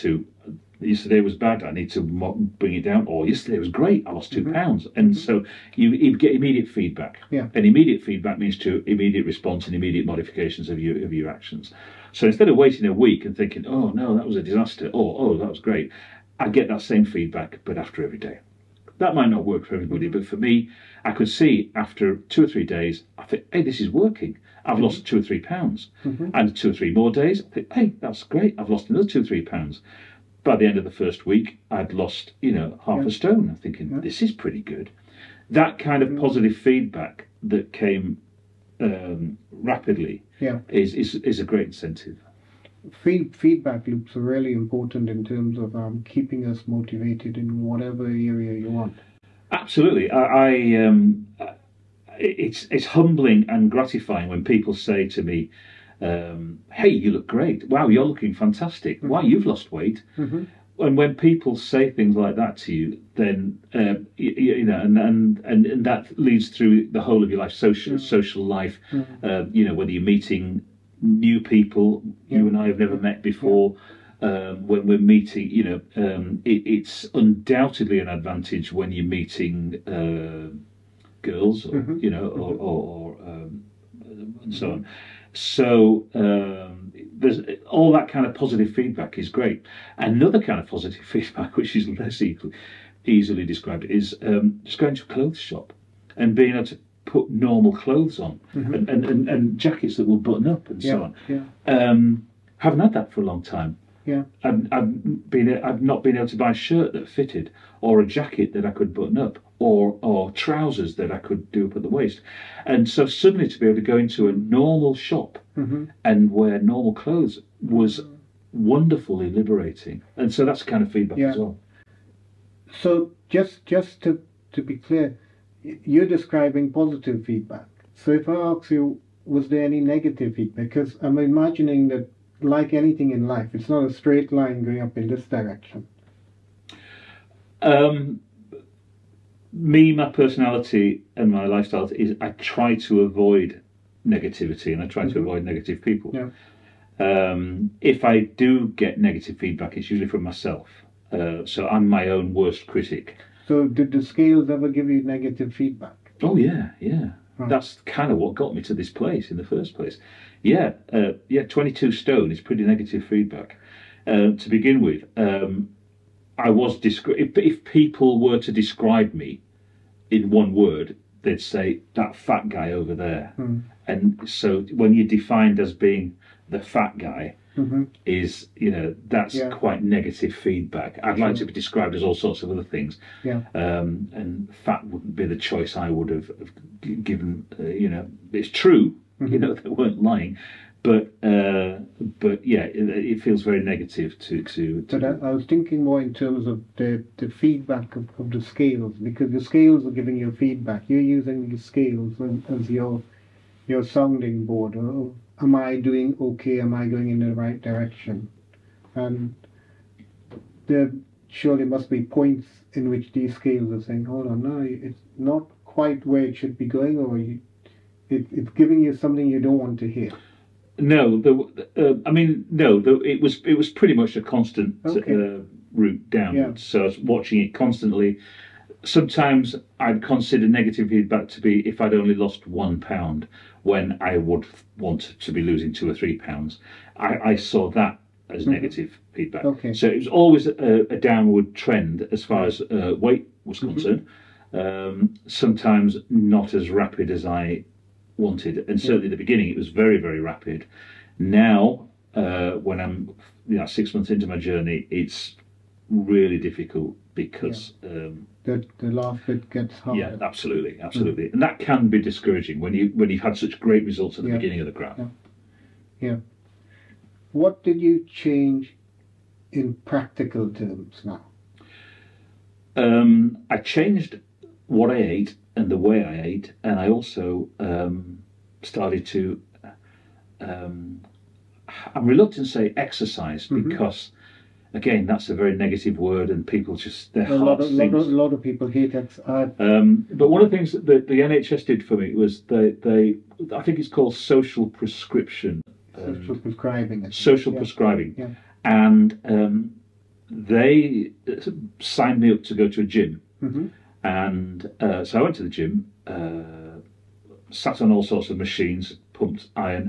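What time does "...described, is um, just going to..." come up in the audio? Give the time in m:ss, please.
1:33.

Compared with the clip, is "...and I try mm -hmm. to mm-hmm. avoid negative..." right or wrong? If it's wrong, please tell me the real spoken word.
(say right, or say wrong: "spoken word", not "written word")
right.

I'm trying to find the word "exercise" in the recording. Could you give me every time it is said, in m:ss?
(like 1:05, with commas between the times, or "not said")
4:42, 4:48.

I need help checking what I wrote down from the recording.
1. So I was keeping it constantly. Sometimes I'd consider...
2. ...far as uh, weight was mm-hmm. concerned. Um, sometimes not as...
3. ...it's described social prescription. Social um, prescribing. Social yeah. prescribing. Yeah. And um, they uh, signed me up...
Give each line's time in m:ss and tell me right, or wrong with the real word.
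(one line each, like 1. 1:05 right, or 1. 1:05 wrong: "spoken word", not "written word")
1. 3:46 wrong: "watching", not "keeping"
2. 4:02 right
3. 4:53 wrong: "called", not "described".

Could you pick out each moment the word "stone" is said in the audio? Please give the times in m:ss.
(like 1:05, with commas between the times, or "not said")
0:33, 2:41.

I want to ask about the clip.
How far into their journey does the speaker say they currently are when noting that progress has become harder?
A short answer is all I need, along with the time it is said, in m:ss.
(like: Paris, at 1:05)
6 months, at 4:13.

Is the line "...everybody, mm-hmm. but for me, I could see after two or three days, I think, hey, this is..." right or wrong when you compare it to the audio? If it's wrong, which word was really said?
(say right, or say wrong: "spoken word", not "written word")
right.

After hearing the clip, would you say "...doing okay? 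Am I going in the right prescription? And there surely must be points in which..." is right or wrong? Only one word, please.
wrong.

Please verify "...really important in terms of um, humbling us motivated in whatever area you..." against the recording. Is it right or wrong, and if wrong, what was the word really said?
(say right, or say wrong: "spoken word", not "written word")
wrong: "keeping", not "humbling".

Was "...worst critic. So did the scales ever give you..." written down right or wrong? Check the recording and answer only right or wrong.
right.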